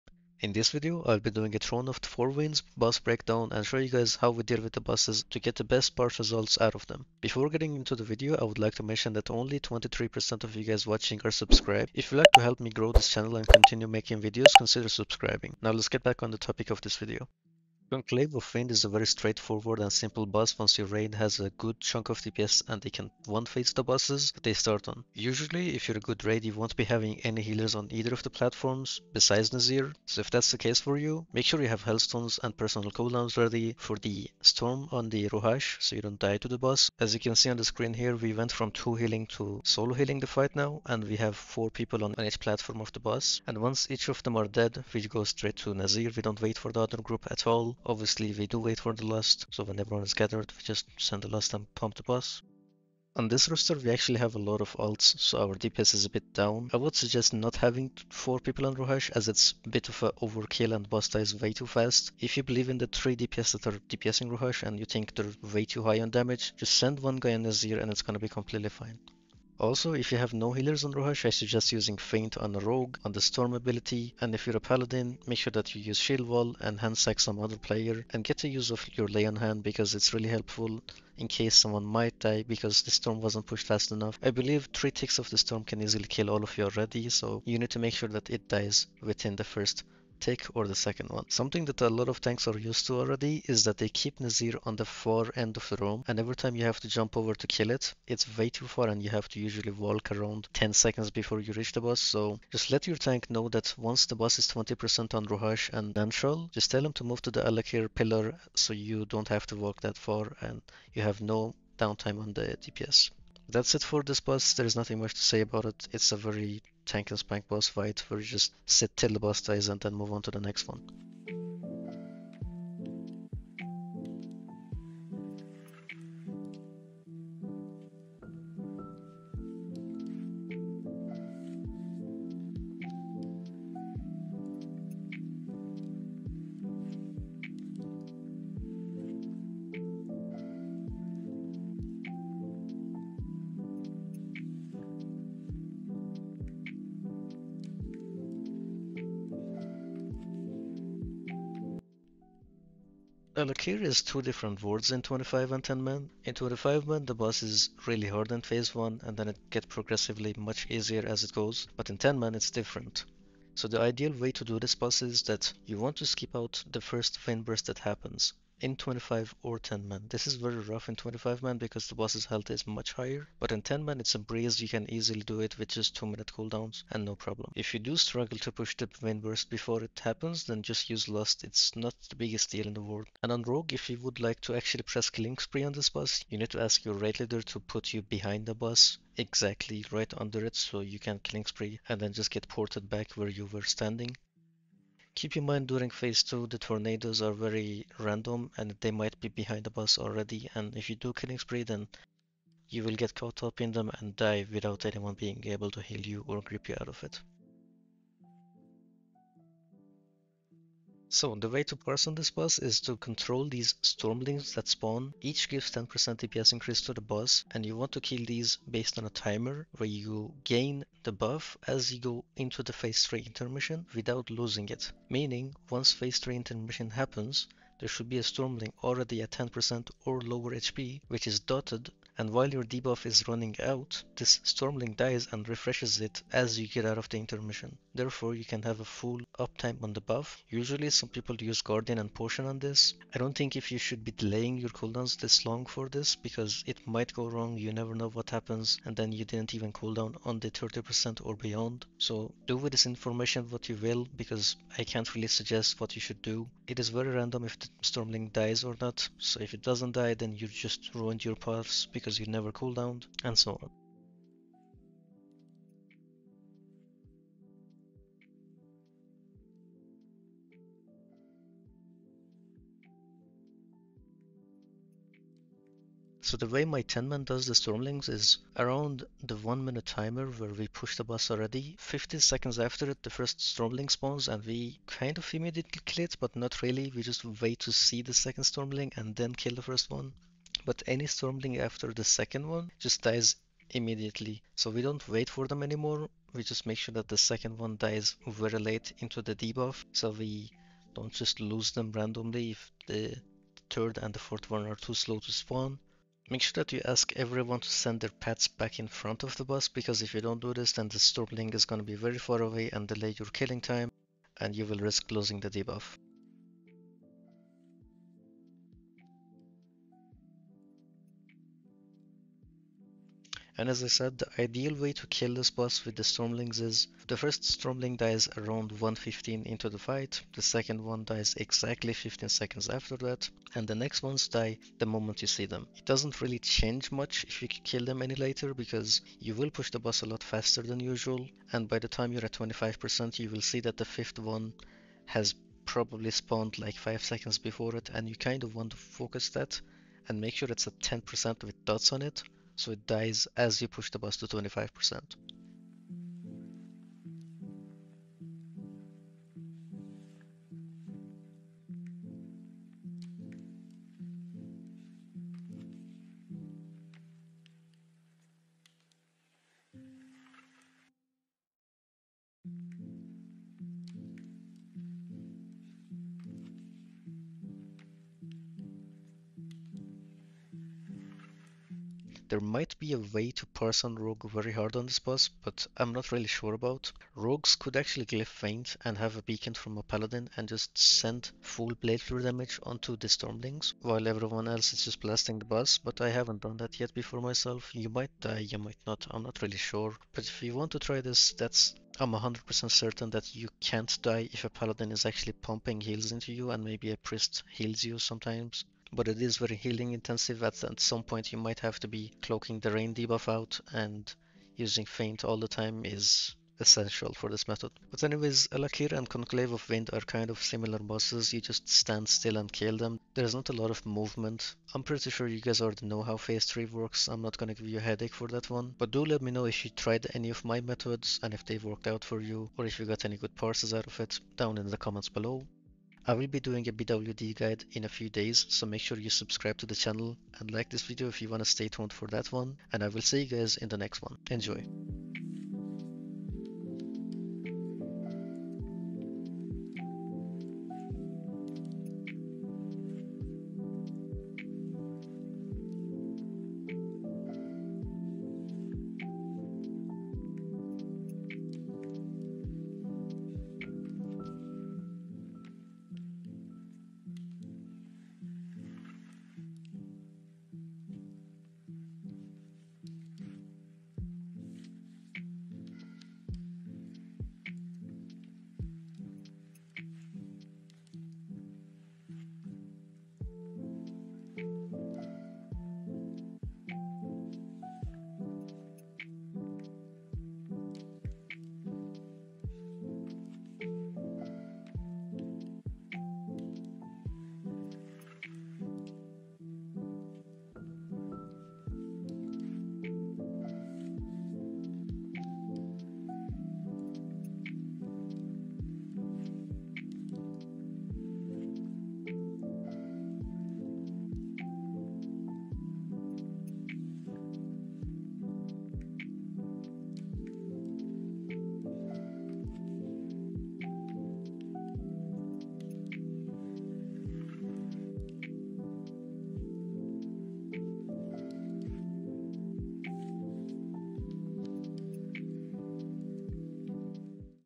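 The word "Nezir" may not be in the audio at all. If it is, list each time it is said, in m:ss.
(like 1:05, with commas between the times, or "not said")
0:29, 0:45, 1:34.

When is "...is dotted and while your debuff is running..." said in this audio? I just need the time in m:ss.
3:51.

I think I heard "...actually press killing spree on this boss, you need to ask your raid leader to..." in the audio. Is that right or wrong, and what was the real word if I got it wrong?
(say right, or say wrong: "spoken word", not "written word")
right.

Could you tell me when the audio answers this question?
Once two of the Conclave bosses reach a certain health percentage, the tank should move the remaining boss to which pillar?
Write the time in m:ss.
1:47.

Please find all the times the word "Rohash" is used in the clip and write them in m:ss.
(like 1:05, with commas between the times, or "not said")
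0:35, 0:58, 1:04, 1:10, 1:45.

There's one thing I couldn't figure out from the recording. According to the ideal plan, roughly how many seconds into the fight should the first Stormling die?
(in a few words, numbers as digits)
115.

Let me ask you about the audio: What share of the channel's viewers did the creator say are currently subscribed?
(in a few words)
23%.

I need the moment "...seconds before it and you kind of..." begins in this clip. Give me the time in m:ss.
5:47.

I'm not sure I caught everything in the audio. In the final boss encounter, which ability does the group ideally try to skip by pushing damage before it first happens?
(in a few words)
Wind Burst.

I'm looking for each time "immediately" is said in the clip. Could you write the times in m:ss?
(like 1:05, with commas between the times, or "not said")
4:45, 4:53.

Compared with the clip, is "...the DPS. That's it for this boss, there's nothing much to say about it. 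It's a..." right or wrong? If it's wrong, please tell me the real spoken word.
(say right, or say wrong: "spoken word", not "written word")
right.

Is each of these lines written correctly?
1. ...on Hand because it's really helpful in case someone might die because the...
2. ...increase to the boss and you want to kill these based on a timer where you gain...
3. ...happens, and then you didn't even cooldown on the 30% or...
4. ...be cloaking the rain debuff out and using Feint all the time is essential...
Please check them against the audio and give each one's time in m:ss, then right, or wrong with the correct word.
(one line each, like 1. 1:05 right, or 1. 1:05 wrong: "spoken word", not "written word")
1. 1:19 right
2. 3:36 right
3. 4:08 right
4. 6:51 right.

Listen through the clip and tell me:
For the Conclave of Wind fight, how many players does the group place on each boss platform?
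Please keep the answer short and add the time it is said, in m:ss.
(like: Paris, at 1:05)
4, at 0:41.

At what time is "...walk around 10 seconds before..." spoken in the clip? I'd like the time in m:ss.
1:39.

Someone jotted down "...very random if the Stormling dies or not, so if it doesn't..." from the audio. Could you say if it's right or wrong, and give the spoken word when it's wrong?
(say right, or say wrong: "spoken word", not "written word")
right.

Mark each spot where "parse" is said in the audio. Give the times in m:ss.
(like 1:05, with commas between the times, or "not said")
3:31, 6:23, 7:13.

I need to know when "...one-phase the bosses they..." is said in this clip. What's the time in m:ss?
0:23.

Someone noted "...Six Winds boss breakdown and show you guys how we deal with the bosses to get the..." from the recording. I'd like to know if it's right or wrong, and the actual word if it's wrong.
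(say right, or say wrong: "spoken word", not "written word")
wrong: "Four", not "Six".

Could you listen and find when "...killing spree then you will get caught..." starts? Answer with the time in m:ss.
3:21.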